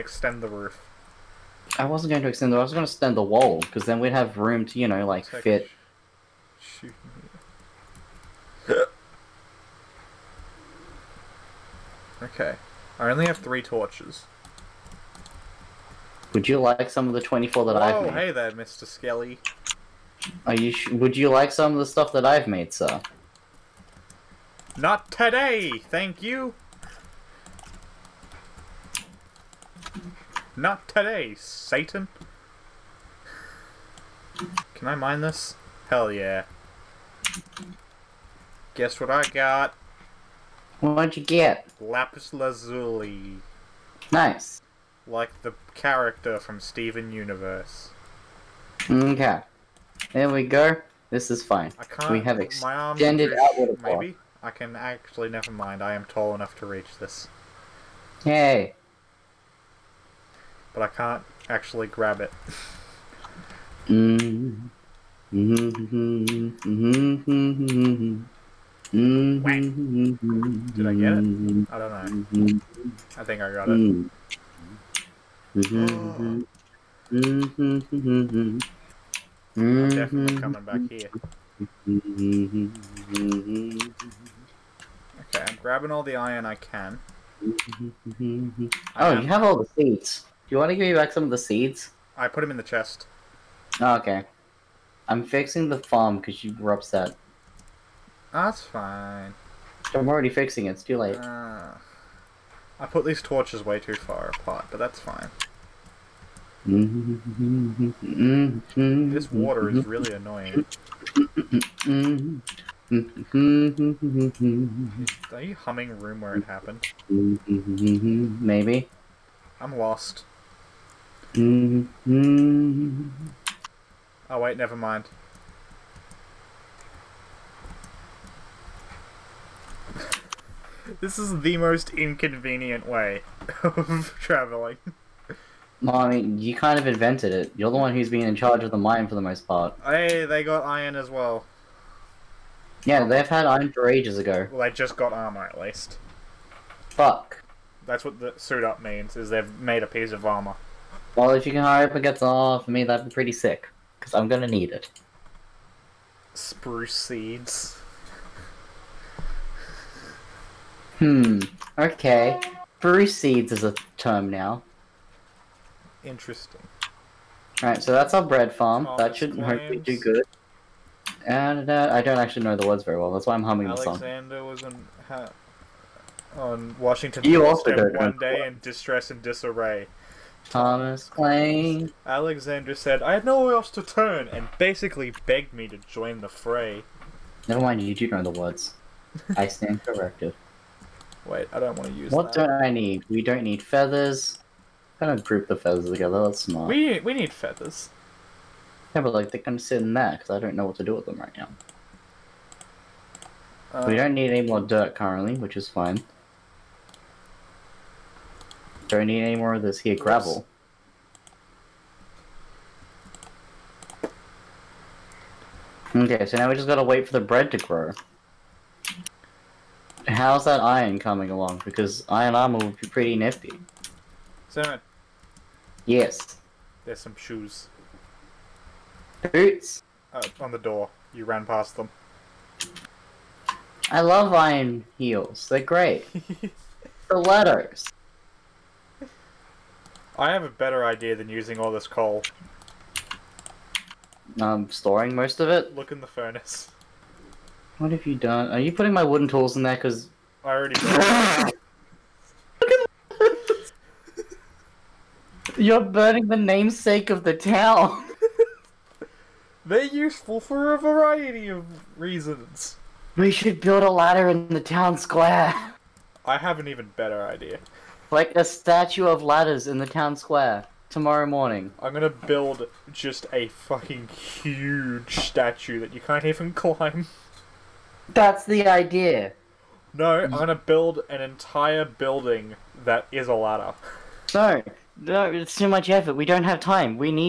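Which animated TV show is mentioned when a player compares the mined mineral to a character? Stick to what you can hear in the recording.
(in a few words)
Steven Universe.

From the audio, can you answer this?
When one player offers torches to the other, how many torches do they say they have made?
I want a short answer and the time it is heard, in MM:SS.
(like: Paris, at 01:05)
24, at 00:17.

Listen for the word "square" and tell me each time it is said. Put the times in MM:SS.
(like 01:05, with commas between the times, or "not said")
04:24, 04:30.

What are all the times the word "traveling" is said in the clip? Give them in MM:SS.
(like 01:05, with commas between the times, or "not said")
02:14.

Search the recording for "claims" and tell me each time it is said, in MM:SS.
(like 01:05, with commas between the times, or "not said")
02:49, 03:01.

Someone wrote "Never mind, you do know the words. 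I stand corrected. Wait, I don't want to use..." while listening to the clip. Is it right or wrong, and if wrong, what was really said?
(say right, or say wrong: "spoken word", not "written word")
right.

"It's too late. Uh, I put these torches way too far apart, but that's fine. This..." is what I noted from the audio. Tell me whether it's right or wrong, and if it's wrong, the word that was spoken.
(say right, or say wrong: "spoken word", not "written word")
right.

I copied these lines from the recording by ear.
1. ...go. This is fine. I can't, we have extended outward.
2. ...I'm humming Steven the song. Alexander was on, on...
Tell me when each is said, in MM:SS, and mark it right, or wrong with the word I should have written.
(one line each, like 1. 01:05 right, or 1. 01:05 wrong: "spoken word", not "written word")
1. 00:50 right
2. 02:53 wrong: "Alexander", not "Steven".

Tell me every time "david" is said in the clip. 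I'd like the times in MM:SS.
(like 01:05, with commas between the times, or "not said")
not said.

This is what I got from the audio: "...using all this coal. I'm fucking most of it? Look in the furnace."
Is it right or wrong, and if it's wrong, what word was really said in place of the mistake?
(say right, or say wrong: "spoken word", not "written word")
wrong: "storing", not "fucking".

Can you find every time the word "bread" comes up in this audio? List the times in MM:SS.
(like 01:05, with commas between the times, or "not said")
02:48, 03:37.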